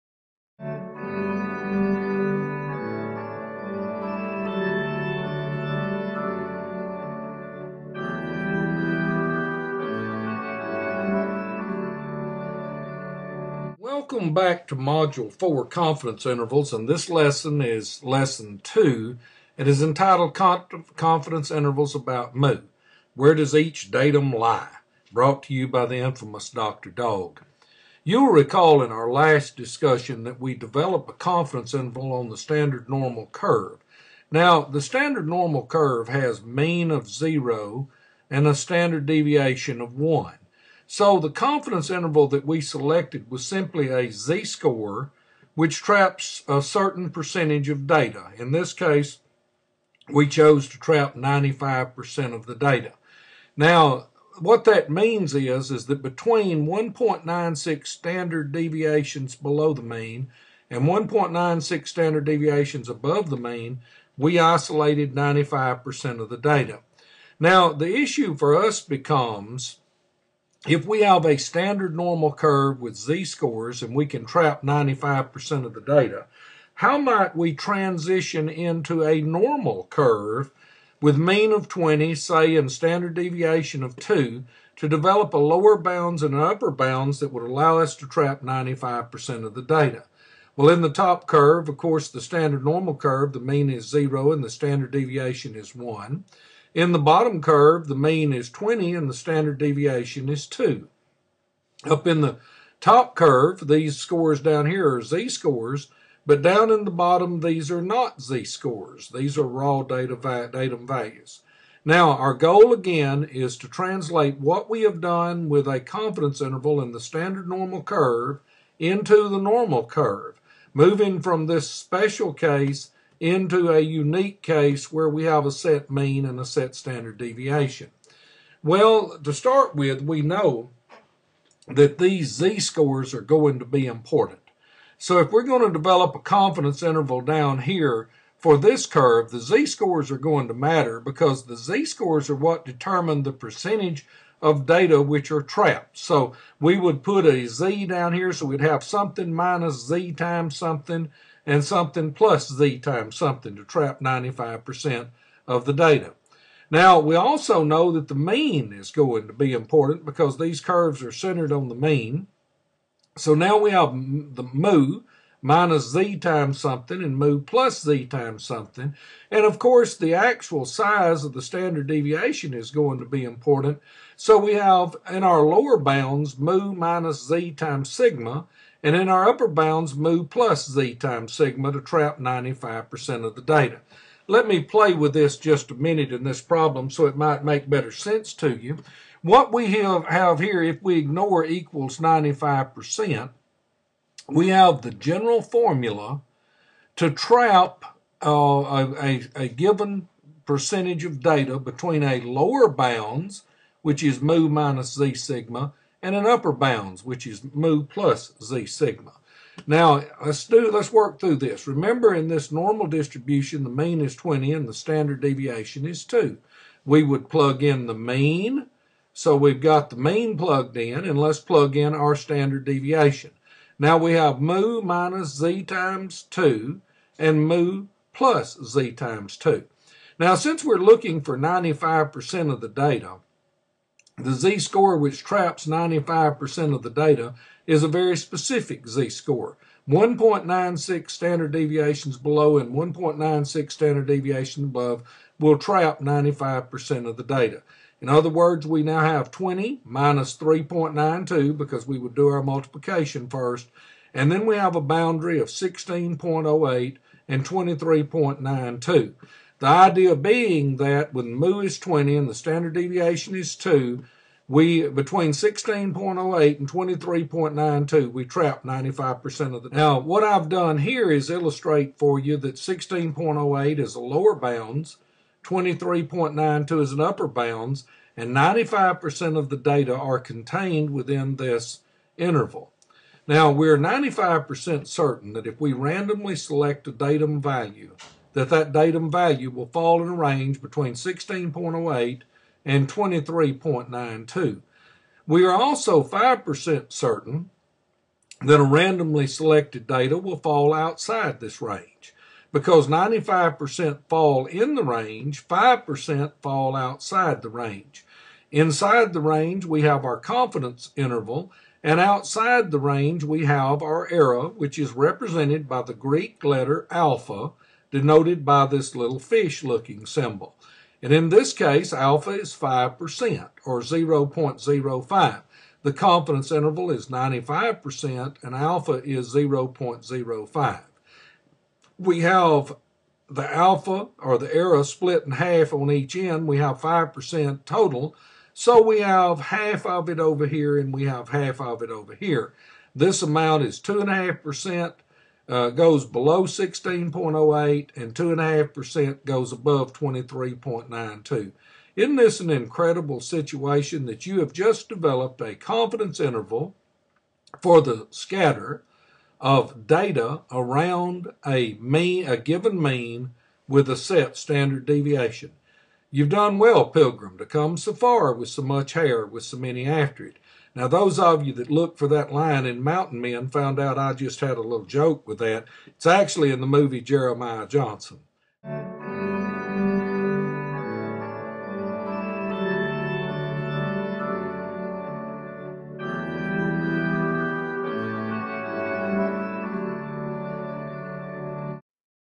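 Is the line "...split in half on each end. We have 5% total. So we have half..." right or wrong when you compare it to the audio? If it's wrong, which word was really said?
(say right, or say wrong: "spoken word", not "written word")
right.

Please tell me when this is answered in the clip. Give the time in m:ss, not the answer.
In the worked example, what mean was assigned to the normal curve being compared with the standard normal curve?
1:21.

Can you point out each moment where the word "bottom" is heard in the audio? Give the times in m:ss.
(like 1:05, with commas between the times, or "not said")
1:36, 1:46.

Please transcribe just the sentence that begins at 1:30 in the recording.
Well, in the top curve, of course, the standard normal curve, the mean is 0 and the standard deviation is 1.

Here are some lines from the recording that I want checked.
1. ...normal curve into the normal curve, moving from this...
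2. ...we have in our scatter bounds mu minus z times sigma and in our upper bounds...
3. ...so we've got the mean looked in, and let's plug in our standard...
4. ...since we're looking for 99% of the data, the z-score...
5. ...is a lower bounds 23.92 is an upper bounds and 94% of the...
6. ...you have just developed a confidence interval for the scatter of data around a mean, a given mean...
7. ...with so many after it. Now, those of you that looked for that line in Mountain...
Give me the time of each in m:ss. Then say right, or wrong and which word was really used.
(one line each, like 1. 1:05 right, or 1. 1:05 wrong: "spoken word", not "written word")
1. 1:57 right
2. 2:54 wrong: "lower", not "scatter"
3. 3:39 wrong: "plugged", not "looked"
4. 3:50 wrong: "95", not "99"
5. 4:33 wrong: "95", not "94"
6. 5:54 right
7. 6:09 right.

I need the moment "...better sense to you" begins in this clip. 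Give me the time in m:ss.
3:07.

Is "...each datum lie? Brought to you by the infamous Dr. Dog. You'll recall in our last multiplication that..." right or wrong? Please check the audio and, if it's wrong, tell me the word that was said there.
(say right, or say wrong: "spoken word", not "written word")
wrong: "discussion", not "multiplication".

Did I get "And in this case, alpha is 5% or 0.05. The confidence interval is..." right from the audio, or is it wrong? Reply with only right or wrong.
right.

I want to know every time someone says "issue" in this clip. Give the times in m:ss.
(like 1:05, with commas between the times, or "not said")
1:07.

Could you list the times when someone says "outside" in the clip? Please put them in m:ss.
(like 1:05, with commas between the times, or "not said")
5:00, 5:06, 5:12.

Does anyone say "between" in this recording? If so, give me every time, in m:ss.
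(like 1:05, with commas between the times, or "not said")
0:56, 3:21, 4:24, 4:50.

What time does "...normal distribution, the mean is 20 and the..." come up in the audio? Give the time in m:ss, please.
3:32.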